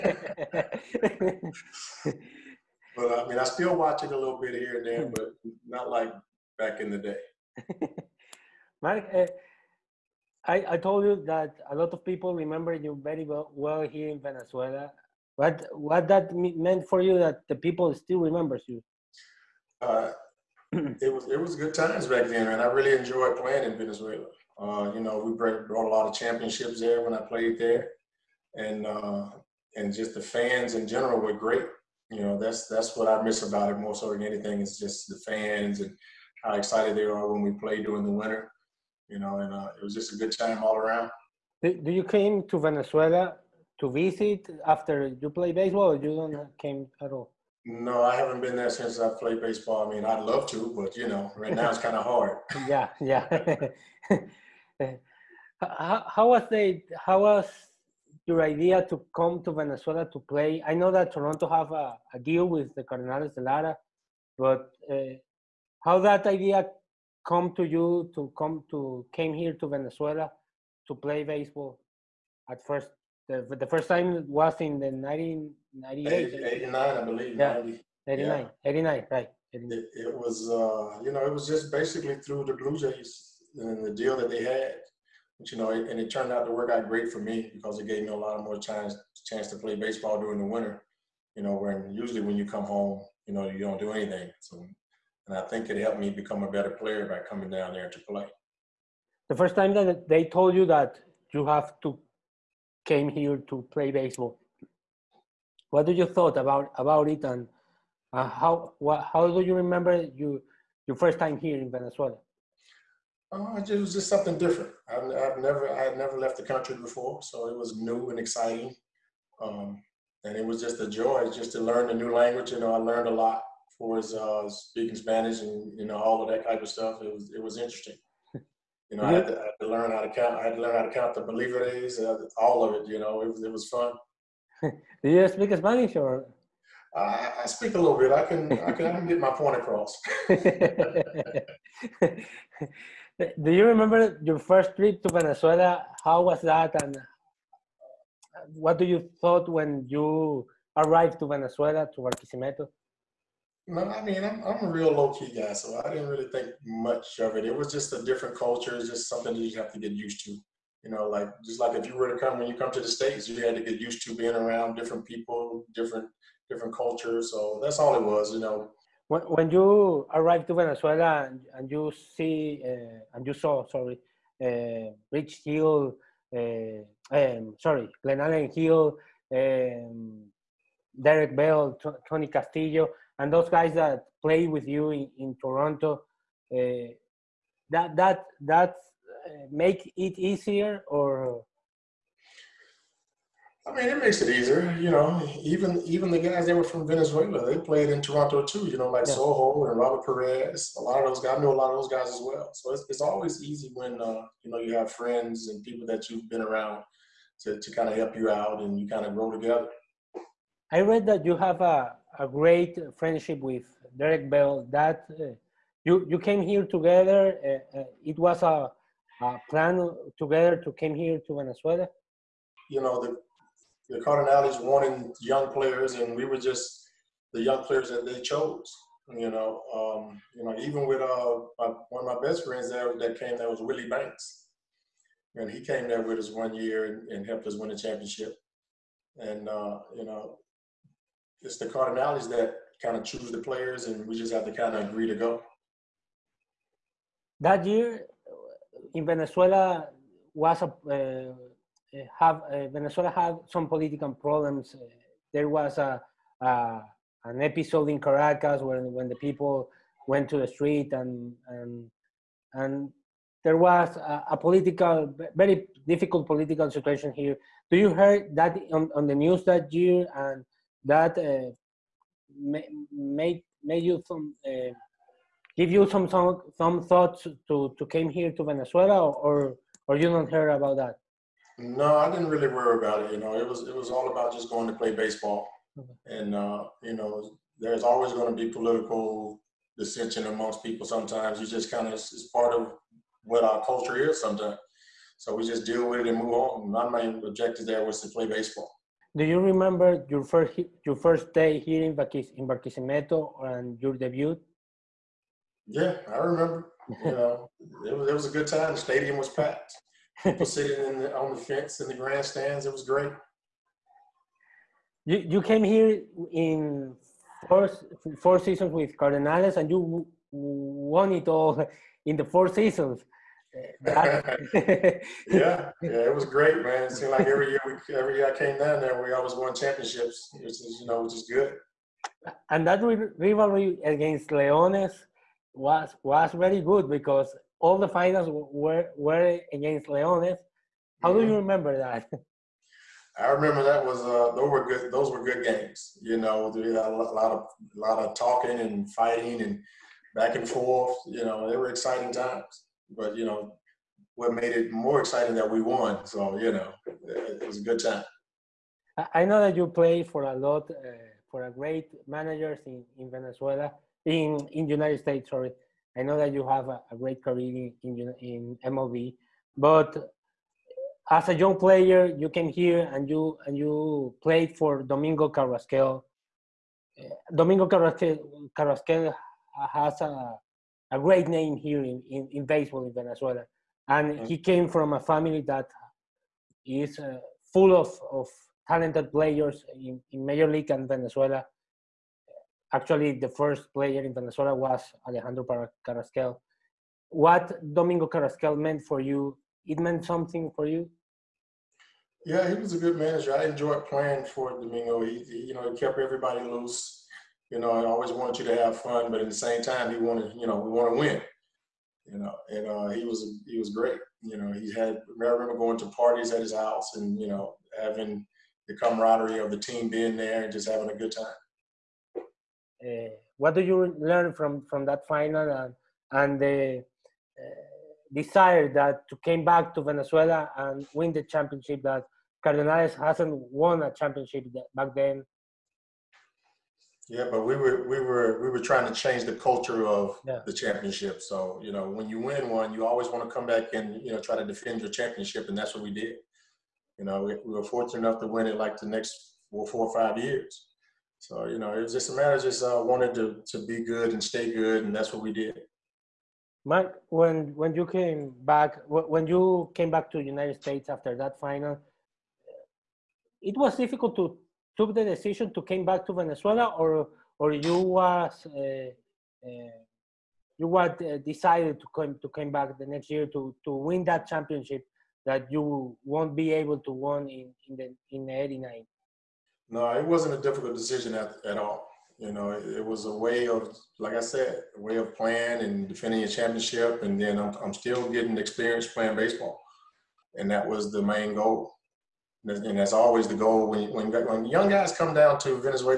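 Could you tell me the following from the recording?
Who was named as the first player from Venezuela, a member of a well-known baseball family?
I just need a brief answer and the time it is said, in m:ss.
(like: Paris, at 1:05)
Alejandro Carrasquel, at 6:35.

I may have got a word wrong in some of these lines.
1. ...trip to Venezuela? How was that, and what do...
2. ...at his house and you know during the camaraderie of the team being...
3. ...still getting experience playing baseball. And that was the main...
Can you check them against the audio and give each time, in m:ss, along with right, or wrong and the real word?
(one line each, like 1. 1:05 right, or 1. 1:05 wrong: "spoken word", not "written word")
1. 2:24 right
2. 6:56 wrong: "having", not "during"
3. 8:07 right.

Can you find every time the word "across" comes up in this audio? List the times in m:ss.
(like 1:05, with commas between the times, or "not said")
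2:19.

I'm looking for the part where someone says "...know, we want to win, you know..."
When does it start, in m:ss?
6:50.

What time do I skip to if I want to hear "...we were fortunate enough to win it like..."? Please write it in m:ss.
7:27.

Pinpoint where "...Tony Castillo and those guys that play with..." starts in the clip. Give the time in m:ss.
3:02.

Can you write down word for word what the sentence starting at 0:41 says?
Do you came to Venezuela to visit after you play baseball?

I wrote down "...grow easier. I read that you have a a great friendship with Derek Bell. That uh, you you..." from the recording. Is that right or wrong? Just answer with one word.
wrong.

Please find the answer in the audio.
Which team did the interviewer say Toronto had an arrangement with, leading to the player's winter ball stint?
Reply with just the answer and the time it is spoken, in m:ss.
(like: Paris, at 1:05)
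Cardinals de Lara, at 1:02.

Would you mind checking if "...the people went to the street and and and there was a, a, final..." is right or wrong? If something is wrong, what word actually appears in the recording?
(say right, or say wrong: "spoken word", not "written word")
wrong: "political", not "final".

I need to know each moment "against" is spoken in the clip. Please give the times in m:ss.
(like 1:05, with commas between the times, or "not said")
5:33, 5:39.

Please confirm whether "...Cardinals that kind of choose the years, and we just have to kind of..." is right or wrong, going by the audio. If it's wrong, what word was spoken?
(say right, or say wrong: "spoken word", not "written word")
wrong: "players", not "years".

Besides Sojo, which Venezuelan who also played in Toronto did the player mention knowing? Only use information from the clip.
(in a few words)
Robert Perez.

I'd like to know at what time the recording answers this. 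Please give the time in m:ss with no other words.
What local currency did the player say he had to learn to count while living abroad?
2:11.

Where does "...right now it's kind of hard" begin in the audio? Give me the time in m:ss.
0:51.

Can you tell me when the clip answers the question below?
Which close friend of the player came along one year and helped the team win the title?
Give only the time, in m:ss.
3:53.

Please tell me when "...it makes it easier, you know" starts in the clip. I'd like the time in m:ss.
3:13.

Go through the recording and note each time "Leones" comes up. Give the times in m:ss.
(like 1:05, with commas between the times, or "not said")
5:34, 5:39.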